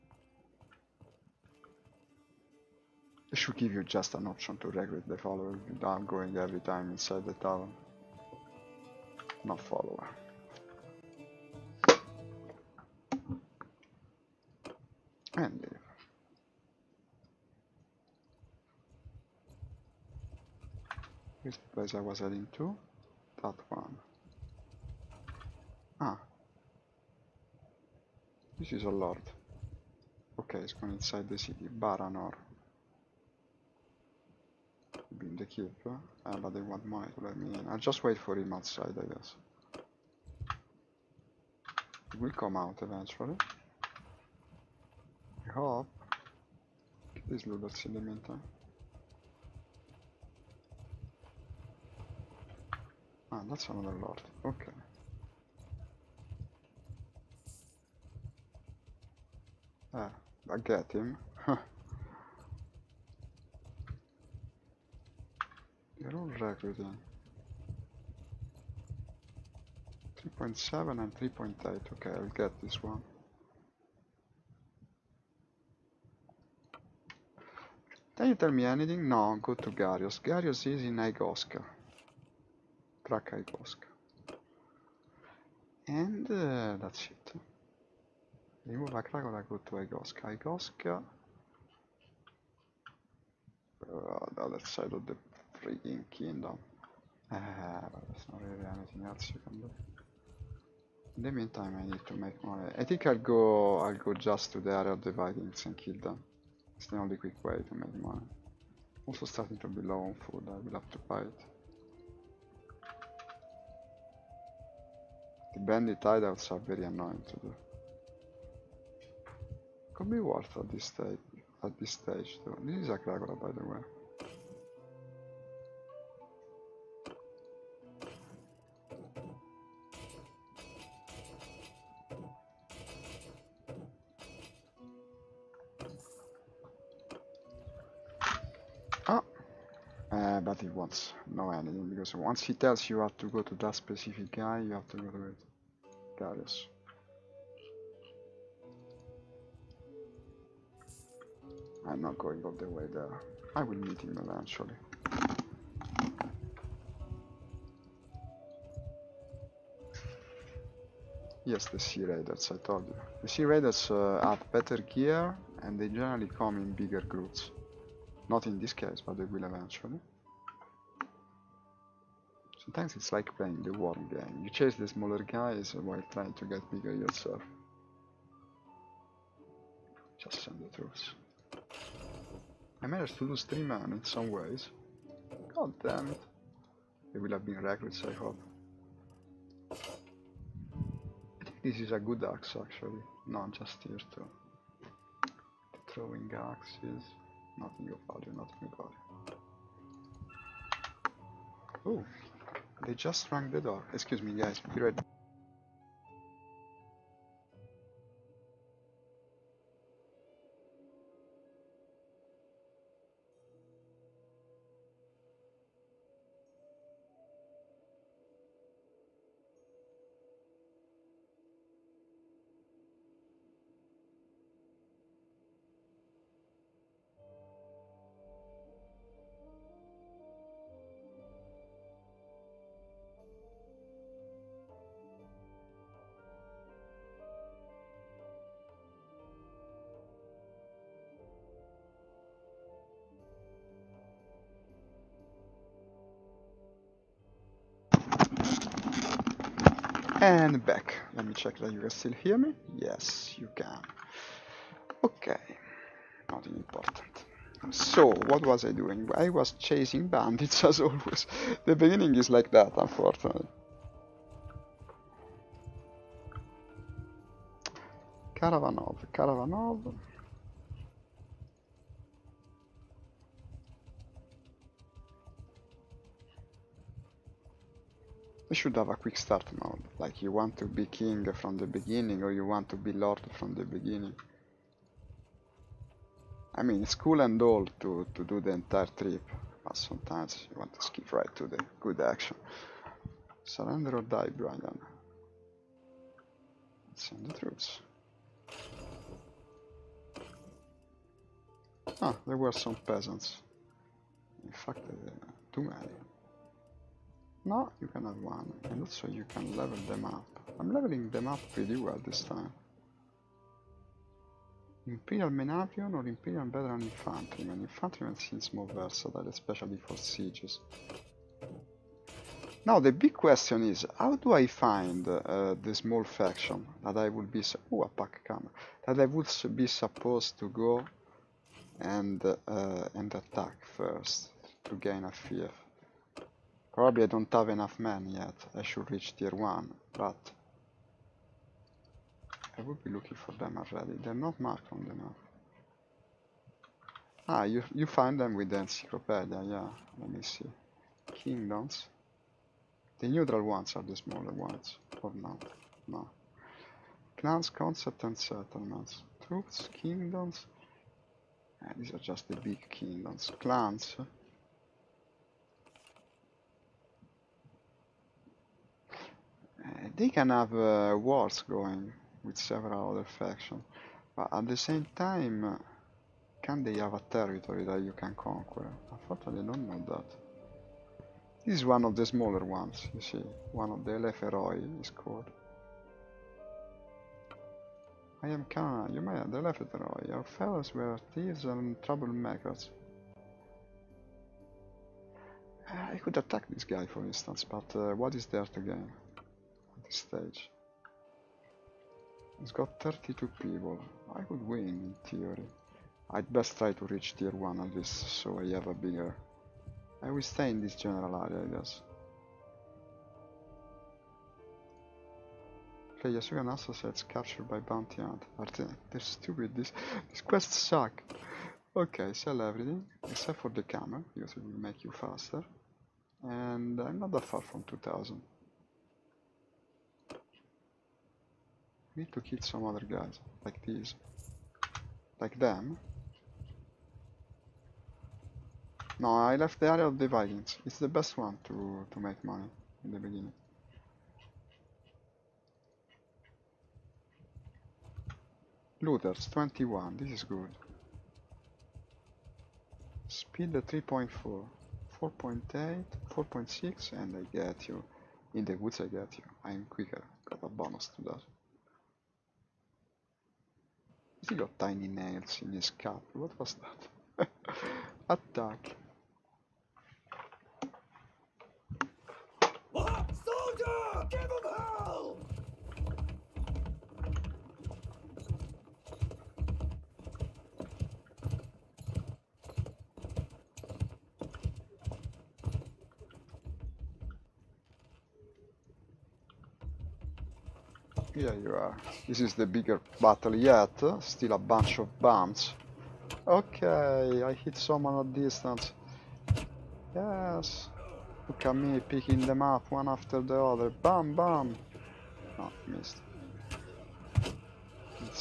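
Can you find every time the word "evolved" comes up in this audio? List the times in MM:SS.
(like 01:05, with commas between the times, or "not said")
not said.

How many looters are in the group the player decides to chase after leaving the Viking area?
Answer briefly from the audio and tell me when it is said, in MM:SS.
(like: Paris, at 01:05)
21, at 07:28.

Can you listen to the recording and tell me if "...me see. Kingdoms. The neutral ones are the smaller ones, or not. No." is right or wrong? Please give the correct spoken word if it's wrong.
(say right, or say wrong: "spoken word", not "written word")
right.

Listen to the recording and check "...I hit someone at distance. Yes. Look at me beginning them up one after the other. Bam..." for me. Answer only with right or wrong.
wrong.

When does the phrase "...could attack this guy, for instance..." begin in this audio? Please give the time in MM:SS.
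06:36.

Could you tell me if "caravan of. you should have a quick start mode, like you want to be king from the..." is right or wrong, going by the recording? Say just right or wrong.
right.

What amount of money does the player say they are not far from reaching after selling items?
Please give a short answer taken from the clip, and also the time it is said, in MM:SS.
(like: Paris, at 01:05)
2000, at 07:07.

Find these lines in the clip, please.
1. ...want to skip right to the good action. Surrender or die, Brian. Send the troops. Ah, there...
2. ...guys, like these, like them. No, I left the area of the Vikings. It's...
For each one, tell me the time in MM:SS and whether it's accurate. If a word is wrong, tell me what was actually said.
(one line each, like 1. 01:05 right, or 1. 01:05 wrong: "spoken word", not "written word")
1. 04:50 right
2. 07:12 right.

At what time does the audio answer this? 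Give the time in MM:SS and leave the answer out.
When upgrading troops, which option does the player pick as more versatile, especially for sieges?
05:16.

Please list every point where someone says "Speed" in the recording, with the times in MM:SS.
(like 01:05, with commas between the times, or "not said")
07:33.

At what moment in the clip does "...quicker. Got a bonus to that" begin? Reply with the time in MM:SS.
07:39.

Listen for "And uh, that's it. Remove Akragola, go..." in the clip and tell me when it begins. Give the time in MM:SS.
01:25.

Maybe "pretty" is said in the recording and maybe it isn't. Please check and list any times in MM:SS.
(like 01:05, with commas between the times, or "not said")
05:11.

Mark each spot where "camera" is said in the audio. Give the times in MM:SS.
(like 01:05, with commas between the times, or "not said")
05:28, 07:03.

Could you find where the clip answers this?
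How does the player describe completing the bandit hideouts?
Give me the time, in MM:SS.
01:56.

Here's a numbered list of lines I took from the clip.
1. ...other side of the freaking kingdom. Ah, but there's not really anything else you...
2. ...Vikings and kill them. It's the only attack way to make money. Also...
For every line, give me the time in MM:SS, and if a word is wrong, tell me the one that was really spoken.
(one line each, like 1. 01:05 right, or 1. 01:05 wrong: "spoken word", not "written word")
1. 01:34 right
2. 01:45 wrong: "quick", not "attack".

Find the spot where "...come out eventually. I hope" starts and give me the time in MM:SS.
00:42.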